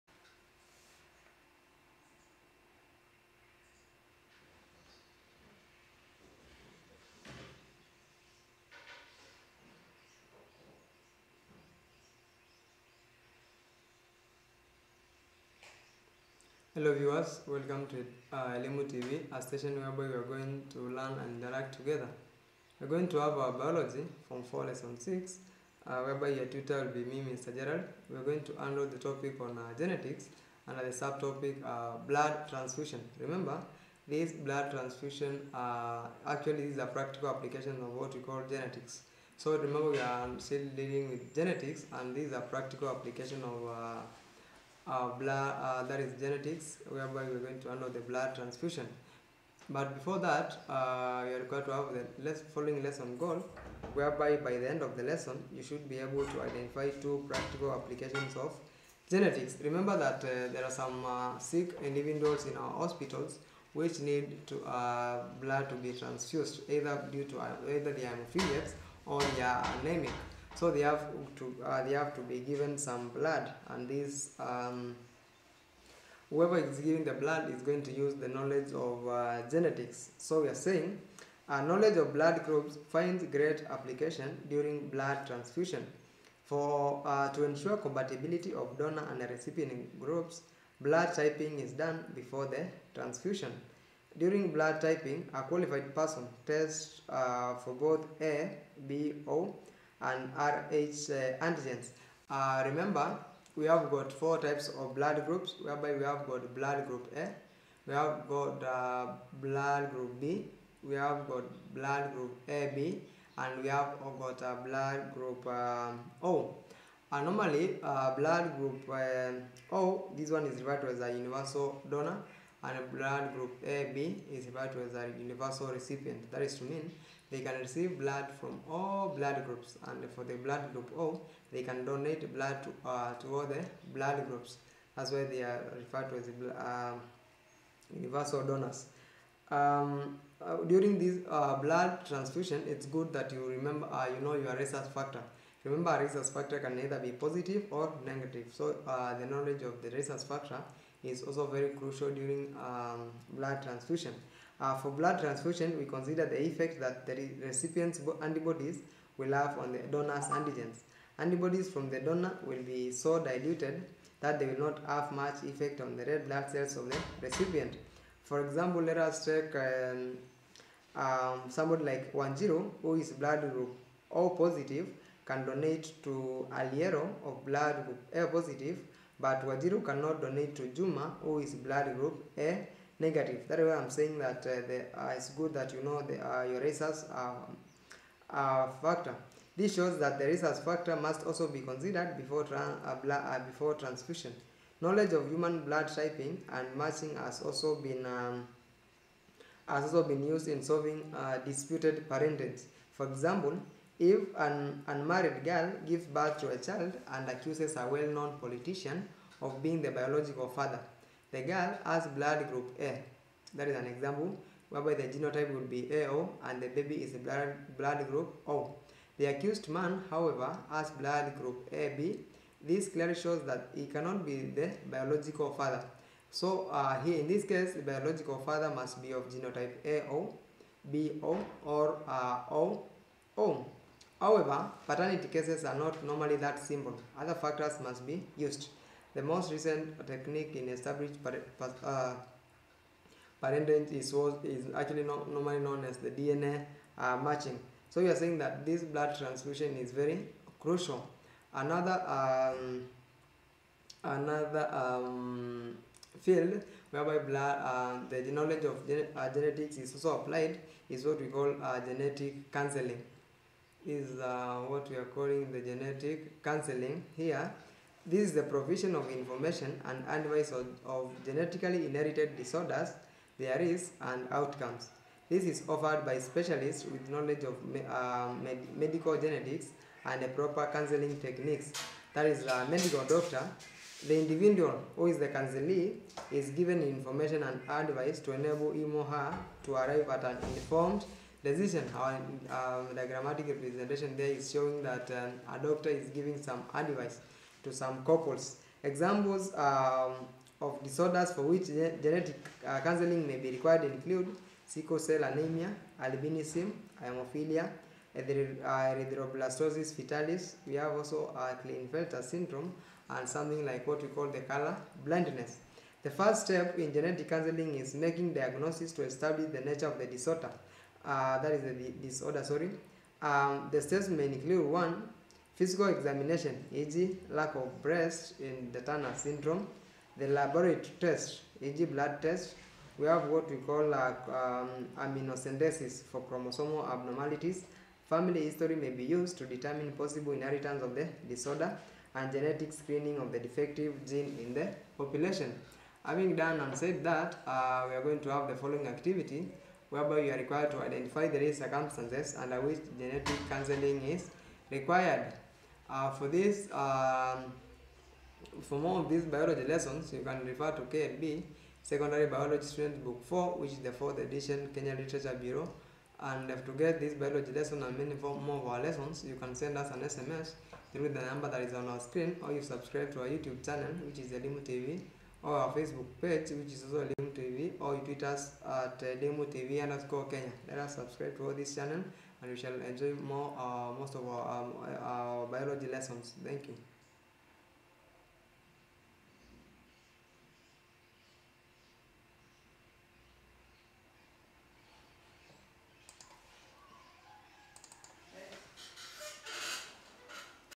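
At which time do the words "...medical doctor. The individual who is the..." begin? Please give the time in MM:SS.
04:42.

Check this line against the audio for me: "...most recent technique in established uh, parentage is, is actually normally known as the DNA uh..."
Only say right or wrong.
right.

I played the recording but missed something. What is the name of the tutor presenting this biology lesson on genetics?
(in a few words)
Mr. Gerald.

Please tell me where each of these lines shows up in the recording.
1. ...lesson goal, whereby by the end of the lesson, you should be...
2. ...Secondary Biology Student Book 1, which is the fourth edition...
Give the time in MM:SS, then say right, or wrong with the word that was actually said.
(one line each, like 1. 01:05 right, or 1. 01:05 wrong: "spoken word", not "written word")
1. 00:52 right
2. 06:01 wrong: "4", not "1".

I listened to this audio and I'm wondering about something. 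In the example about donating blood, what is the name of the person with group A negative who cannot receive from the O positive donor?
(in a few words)
Juma.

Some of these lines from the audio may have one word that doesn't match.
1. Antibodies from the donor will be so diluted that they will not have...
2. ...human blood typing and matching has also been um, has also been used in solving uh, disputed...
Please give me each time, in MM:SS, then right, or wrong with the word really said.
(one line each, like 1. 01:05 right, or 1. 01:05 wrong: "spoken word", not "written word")
1. 02:41 right
2. 03:15 right.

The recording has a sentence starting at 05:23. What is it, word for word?
Um, the steps may include one, physical examination, e.g.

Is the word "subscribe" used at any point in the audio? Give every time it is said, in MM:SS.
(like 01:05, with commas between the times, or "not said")
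06:12, 06:20.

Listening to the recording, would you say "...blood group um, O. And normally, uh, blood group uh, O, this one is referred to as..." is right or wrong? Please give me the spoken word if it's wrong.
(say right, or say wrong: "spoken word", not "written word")
right.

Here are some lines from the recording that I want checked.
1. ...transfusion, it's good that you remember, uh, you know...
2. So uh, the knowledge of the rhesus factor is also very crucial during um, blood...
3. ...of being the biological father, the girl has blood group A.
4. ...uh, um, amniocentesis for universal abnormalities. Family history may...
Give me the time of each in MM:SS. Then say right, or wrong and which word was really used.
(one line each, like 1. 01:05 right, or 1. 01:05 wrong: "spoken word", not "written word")
1. 02:22 right
2. 02:28 right
3. 03:29 right
4. 05:34 wrong: "chromosomal", not "universal".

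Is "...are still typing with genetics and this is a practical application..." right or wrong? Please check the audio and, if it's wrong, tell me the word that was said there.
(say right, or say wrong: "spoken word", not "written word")
wrong: "dealing", not "typing".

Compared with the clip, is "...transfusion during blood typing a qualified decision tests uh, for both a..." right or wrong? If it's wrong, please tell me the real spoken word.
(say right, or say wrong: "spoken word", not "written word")
wrong: "person", not "decision".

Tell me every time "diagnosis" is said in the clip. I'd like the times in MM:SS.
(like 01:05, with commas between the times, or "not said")
05:18.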